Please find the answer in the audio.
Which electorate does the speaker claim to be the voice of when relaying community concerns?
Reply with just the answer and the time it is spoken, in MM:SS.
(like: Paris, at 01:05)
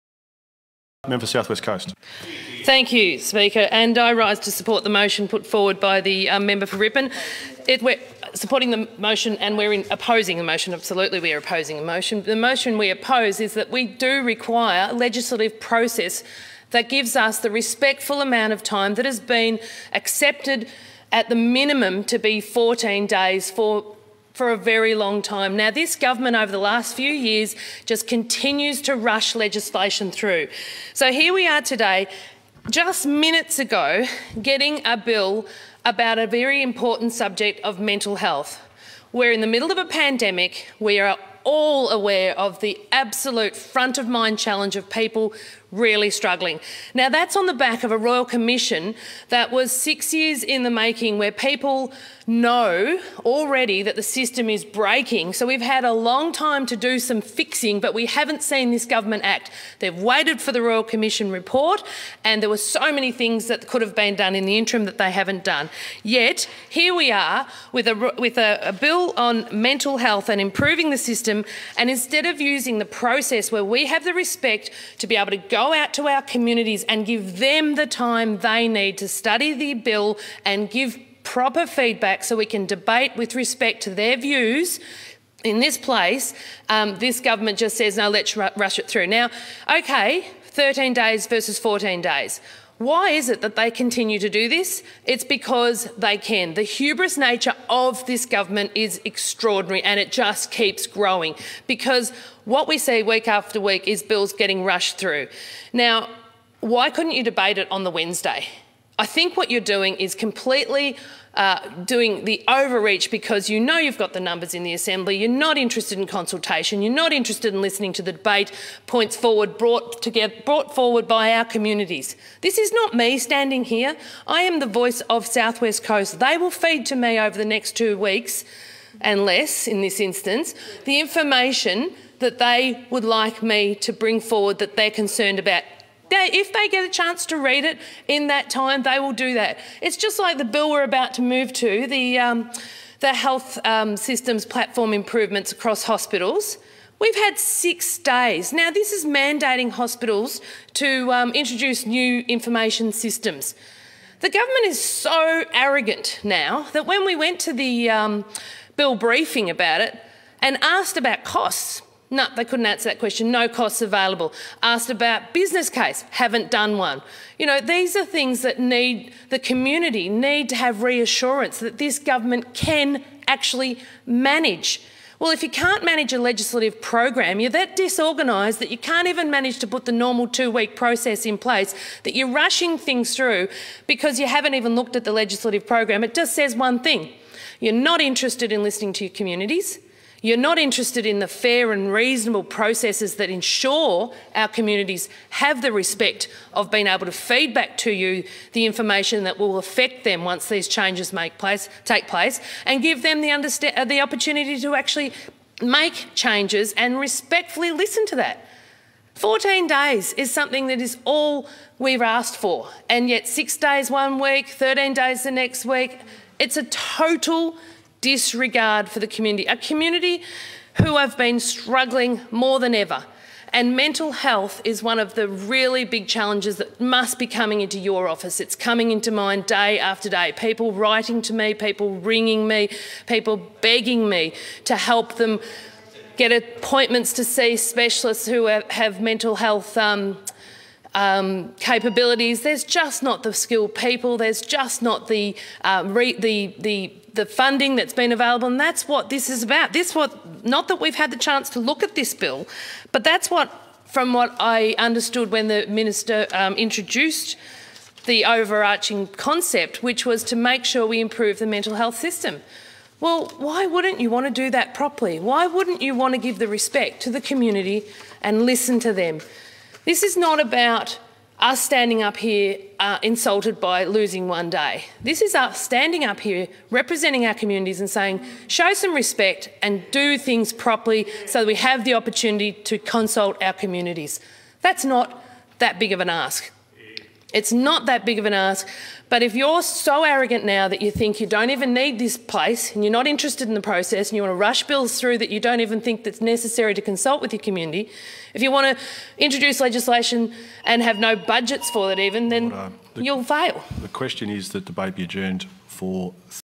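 Southwest Coast, at 02:05.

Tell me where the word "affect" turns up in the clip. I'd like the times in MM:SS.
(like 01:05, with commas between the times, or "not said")
03:19.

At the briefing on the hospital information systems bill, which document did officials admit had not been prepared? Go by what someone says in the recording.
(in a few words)
Business case.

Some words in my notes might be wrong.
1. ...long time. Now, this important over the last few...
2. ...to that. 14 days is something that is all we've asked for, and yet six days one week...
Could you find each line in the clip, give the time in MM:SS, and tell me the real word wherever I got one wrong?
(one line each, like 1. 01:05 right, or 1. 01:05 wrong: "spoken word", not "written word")
1. 00:24 wrong: "government", not "important"
2. 03:28 right.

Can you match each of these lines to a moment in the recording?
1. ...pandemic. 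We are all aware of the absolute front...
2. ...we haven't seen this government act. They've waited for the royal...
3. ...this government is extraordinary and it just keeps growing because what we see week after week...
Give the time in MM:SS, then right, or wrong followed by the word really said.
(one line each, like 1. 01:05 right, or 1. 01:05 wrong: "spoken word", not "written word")
1. 00:39 right
2. 00:57 right
3. 01:38 right.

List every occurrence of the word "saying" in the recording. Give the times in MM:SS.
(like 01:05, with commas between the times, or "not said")
04:37.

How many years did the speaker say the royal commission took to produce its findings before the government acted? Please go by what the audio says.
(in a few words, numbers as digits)
6.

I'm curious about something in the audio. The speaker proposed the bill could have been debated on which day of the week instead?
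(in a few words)
Wednesday.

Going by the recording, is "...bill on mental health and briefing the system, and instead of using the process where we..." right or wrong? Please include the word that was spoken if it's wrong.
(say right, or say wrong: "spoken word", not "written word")
wrong: "improving", not "briefing".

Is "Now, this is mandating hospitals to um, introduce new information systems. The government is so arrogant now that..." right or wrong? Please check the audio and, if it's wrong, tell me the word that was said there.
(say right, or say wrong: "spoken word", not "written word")
right.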